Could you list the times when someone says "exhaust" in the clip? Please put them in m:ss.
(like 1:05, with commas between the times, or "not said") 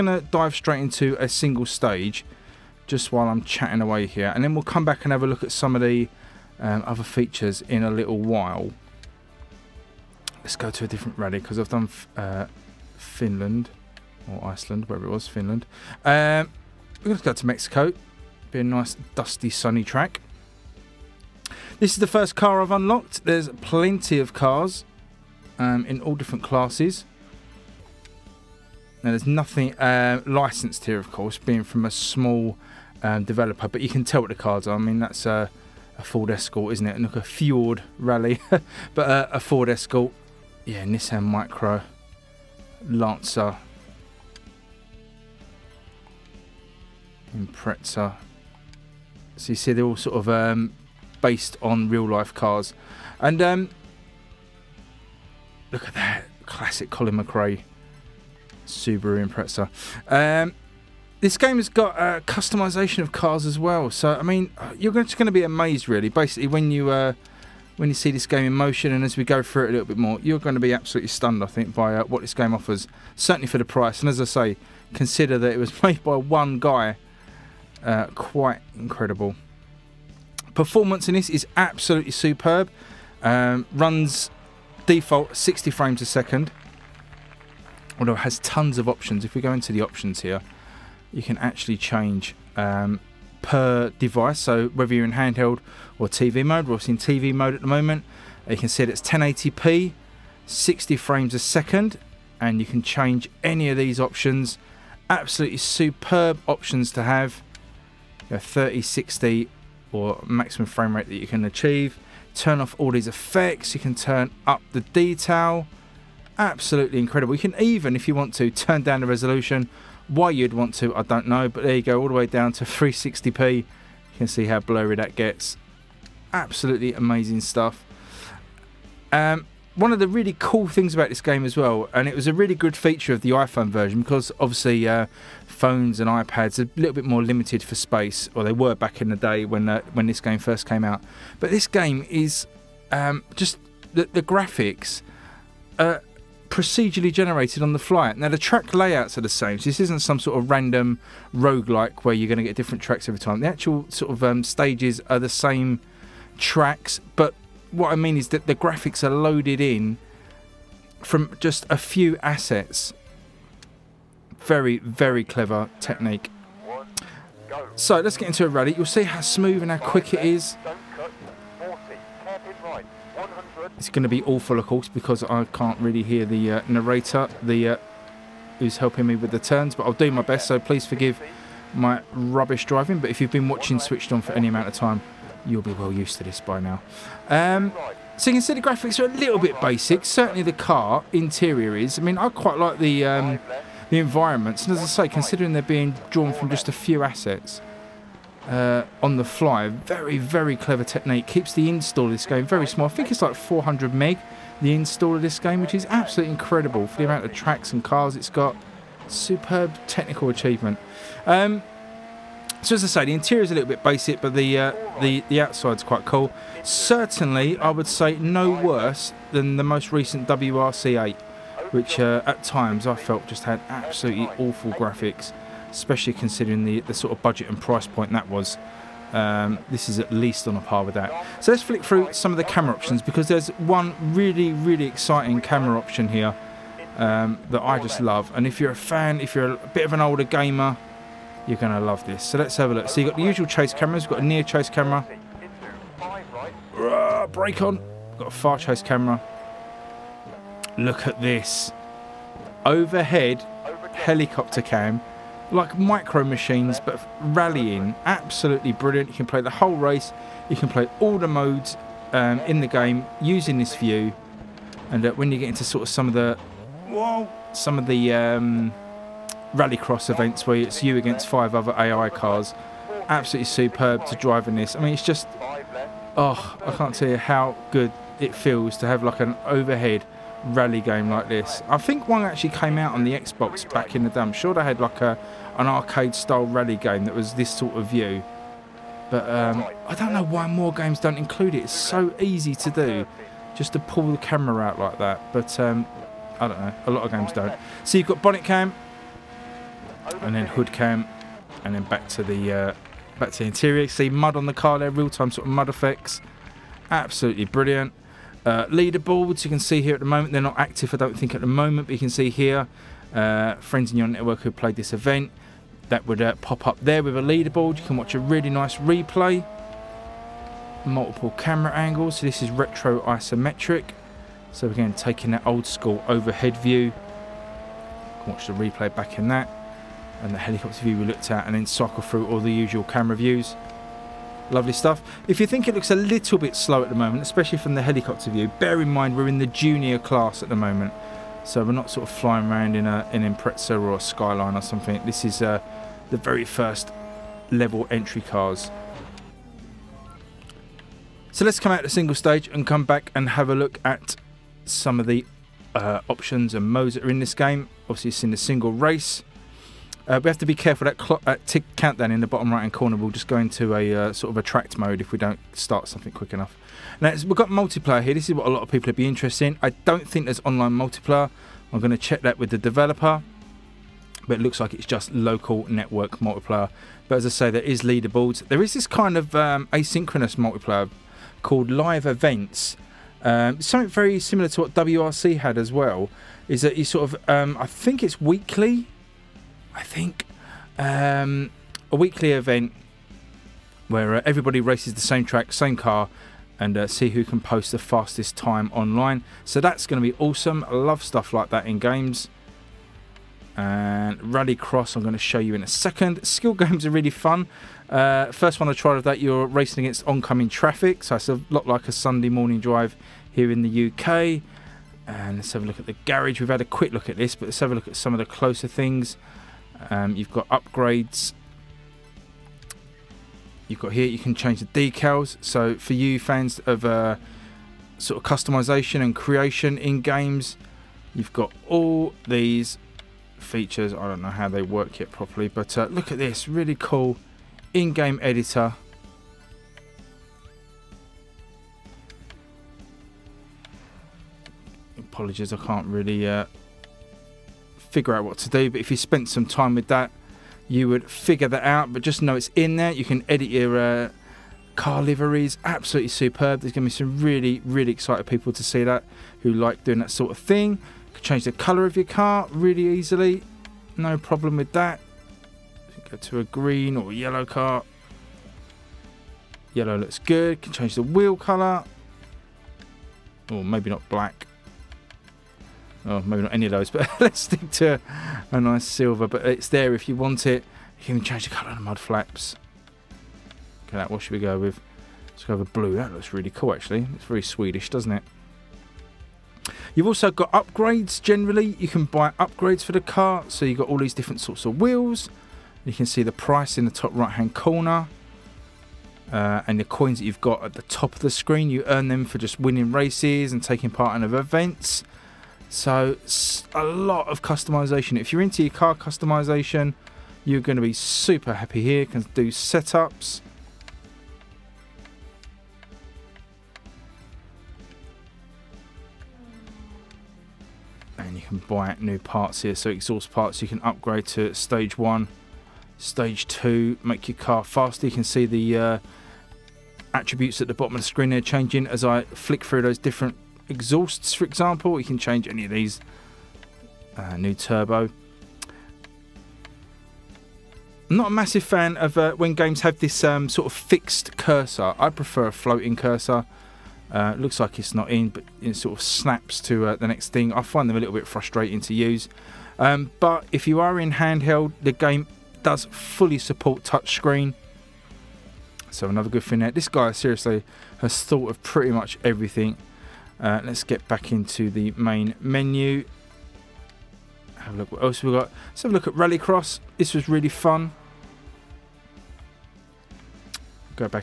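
8:42, 8:53.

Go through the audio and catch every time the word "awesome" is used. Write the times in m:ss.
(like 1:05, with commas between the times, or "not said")
6:40.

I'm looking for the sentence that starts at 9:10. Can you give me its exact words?
I find them a little bit frustrating to use.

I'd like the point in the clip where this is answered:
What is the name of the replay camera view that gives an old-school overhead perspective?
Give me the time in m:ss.
5:22.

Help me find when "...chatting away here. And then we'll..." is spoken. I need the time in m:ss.
0:03.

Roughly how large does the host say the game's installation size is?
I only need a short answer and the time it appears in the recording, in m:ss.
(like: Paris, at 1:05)
400 meg, at 3:23.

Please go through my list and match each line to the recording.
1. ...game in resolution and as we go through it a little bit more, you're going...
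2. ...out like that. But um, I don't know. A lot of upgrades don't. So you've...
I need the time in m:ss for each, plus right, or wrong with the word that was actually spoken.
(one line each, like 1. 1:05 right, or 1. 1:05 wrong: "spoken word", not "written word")
1. 1:08 wrong: "motion", not "resolution"
2. 4:54 wrong: "games", not "upgrades".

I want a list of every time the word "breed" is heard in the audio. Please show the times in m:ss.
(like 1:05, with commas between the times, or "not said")
not said.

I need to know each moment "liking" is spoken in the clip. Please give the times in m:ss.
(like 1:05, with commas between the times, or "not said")
not said.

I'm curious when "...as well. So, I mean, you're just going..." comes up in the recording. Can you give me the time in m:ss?
1:03.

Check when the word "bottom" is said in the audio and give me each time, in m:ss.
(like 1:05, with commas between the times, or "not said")
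6:02, 8:50.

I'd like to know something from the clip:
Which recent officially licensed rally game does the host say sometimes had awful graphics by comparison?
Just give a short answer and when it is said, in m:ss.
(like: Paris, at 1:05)
WRC8, at 3:40.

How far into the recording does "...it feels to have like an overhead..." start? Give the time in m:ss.
4:38.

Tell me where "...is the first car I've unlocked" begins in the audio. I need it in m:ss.
0:21.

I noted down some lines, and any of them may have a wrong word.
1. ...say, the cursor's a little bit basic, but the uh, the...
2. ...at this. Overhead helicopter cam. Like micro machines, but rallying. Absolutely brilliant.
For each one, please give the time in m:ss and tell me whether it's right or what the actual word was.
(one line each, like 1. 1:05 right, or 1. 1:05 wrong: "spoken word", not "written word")
1. 3:32 wrong: "interior", not "cursor"
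2. 4:11 right.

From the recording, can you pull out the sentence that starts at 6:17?
But as I say, there is leaderboards.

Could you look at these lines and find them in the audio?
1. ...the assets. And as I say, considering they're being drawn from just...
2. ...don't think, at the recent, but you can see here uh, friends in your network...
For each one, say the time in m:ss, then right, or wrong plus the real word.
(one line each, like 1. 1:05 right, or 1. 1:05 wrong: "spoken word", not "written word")
1. 3:13 wrong: "environments", not "assets"
2. 5:10 wrong: "moment", not "recent".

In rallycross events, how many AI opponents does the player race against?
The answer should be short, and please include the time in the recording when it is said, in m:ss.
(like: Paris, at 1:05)
5, at 4:31.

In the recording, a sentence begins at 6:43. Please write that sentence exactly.
And Rallycross, I'm going to show you in a second.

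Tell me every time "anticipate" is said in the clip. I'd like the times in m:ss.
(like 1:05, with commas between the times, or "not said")
not said.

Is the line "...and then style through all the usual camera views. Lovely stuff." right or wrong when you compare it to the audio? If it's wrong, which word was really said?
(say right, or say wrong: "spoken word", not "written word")
wrong: "cycle", not "style".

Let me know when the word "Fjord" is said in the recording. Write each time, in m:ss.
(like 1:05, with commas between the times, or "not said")
0:37.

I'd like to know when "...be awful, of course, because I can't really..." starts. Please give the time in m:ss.
2:54.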